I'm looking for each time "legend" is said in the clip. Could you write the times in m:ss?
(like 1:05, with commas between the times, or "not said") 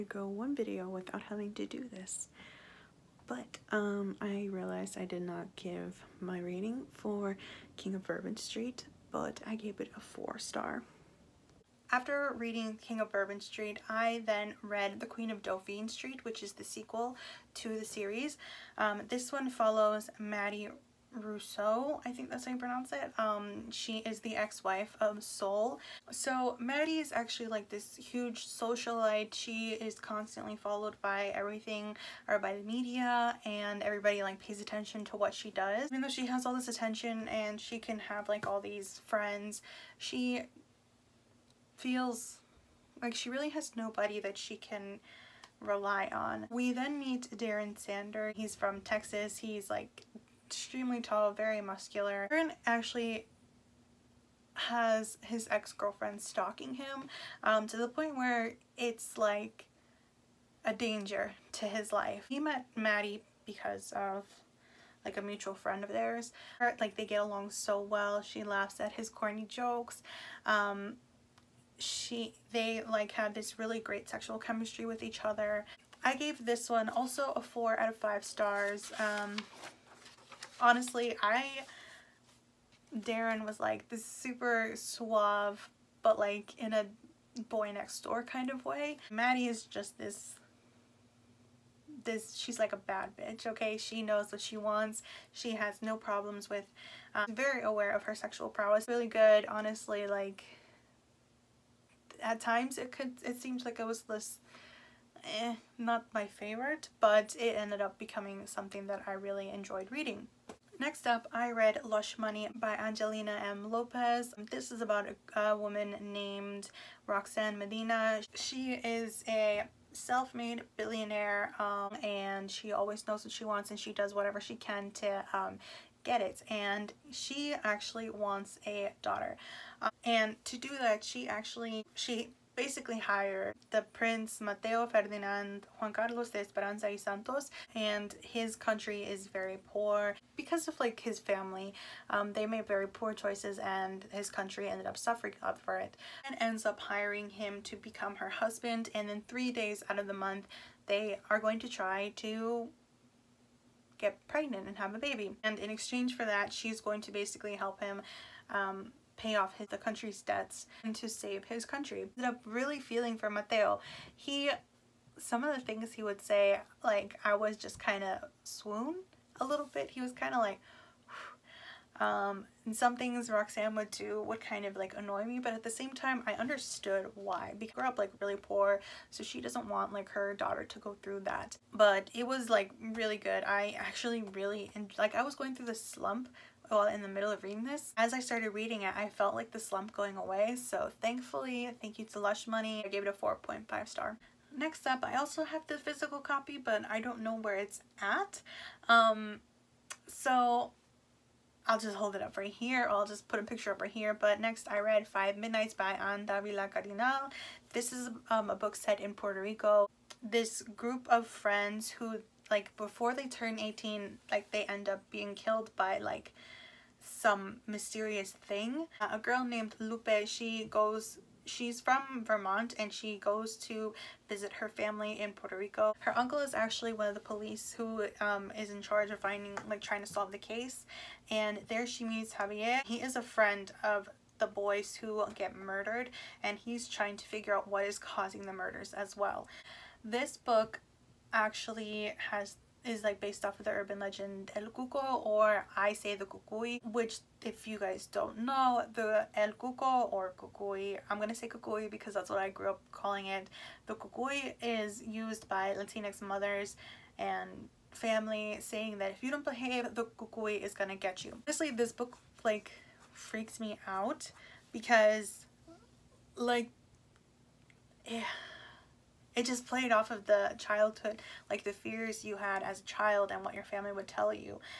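4:03.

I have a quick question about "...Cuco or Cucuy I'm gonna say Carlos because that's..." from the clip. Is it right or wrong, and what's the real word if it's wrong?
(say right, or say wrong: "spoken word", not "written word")
wrong: "Cucuy", not "Carlos".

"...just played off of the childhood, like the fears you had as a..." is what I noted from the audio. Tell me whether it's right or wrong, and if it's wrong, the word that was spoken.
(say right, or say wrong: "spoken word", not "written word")
right.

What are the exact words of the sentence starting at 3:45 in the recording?
Her uncle is actually one of the police who um, is in charge of finding, like trying to solve the case.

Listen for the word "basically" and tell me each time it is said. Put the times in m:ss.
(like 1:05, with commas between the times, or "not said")
2:12, 2:37.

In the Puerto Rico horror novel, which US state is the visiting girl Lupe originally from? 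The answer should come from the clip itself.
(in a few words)
Vermont.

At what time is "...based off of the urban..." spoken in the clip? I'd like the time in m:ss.
4:03.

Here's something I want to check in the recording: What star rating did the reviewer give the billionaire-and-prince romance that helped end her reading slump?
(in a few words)
4.5.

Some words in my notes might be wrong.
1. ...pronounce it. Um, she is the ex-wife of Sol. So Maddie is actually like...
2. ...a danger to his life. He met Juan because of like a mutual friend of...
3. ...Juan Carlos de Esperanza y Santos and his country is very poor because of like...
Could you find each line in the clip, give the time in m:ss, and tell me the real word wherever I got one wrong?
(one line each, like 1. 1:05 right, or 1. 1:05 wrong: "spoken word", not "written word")
1. 0:22 right
2. 1:00 wrong: "Maddie", not "Juan"
3. 2:15 right.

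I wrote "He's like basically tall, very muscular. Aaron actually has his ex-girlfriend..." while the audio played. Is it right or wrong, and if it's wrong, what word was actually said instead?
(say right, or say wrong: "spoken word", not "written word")
wrong: "extremely", not "basically".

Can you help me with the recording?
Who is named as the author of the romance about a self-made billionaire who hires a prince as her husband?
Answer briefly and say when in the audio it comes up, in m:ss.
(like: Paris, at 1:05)
Angelina M. Lopez, at 1:52.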